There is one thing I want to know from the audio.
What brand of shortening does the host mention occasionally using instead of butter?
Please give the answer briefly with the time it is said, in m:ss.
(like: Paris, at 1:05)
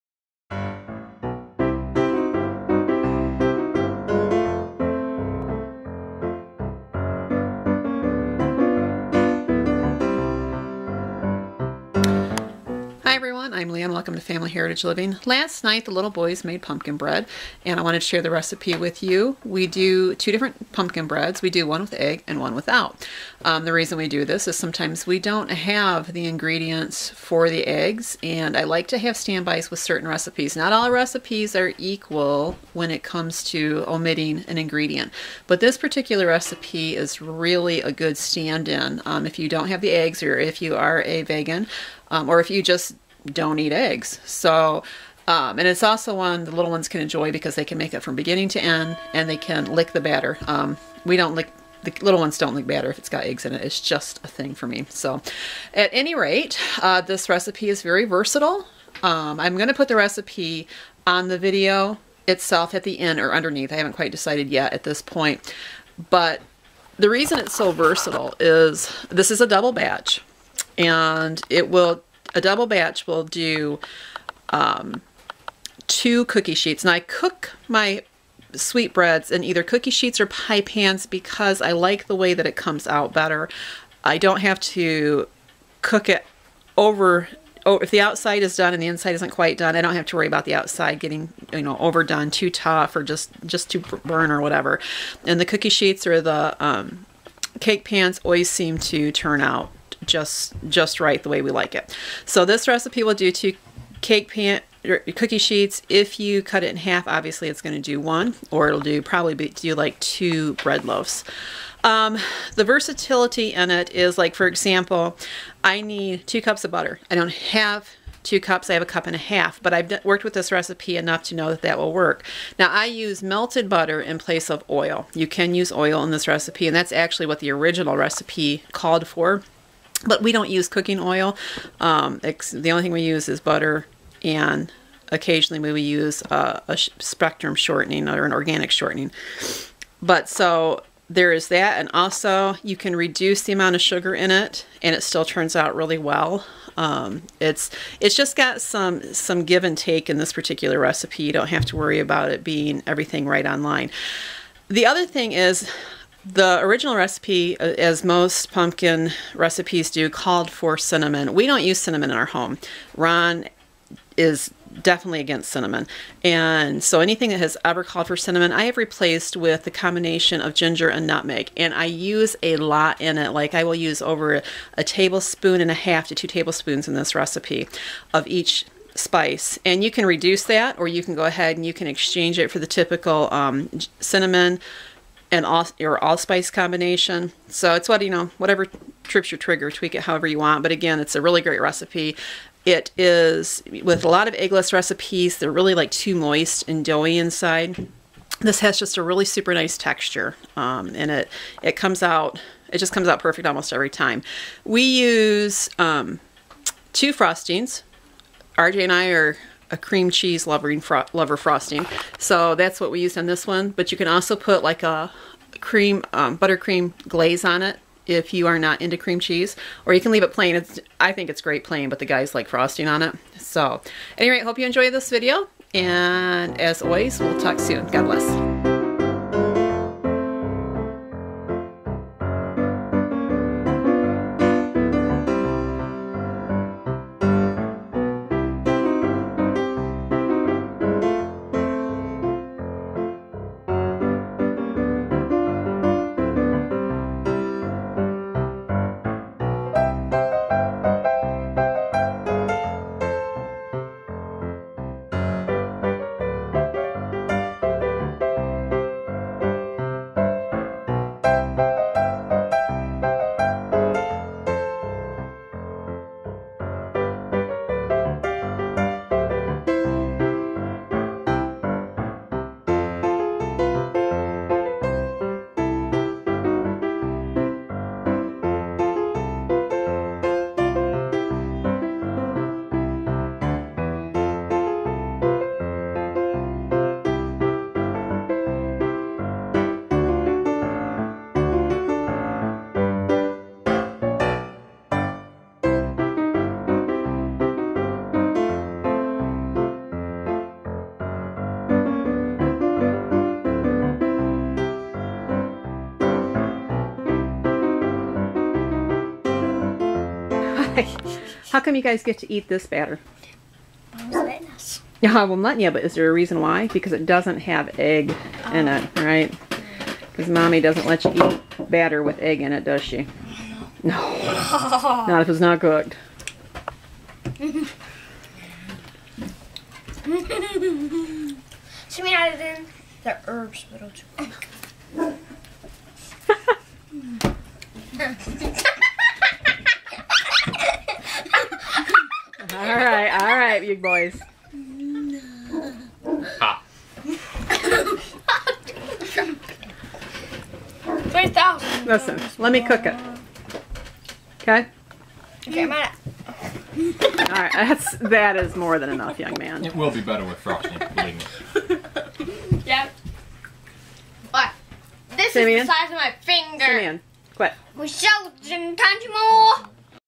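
Spectrum, at 2:16.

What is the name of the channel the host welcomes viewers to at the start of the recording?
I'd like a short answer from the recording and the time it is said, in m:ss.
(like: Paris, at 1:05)
Family Heritage Living, at 0:14.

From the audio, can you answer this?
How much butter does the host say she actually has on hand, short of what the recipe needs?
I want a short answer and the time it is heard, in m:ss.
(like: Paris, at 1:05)
a cup and a half, at 1:58.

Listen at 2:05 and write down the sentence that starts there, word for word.
You can use oil in this recipe, and that's actually what the original recipe called for.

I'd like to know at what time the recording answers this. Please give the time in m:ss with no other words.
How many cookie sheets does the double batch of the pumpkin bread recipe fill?
1:15.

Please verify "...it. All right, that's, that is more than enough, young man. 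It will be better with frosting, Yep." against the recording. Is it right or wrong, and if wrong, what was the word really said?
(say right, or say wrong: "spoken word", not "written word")
right.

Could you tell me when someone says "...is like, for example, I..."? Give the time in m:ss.
1:53.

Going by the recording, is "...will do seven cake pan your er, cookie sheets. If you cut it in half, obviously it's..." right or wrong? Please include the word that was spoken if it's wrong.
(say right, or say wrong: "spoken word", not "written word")
wrong: "two", not "seven".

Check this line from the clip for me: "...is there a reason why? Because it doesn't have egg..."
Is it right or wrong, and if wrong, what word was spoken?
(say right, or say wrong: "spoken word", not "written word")
right.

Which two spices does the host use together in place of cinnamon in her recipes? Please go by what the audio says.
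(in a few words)
ginger and nutmeg.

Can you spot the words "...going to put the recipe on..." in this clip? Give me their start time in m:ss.
0:59.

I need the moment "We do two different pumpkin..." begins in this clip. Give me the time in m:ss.
0:19.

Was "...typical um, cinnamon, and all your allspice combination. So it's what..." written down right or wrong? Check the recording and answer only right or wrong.
right.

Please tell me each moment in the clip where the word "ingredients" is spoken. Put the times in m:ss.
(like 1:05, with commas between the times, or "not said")
0:26, 0:34.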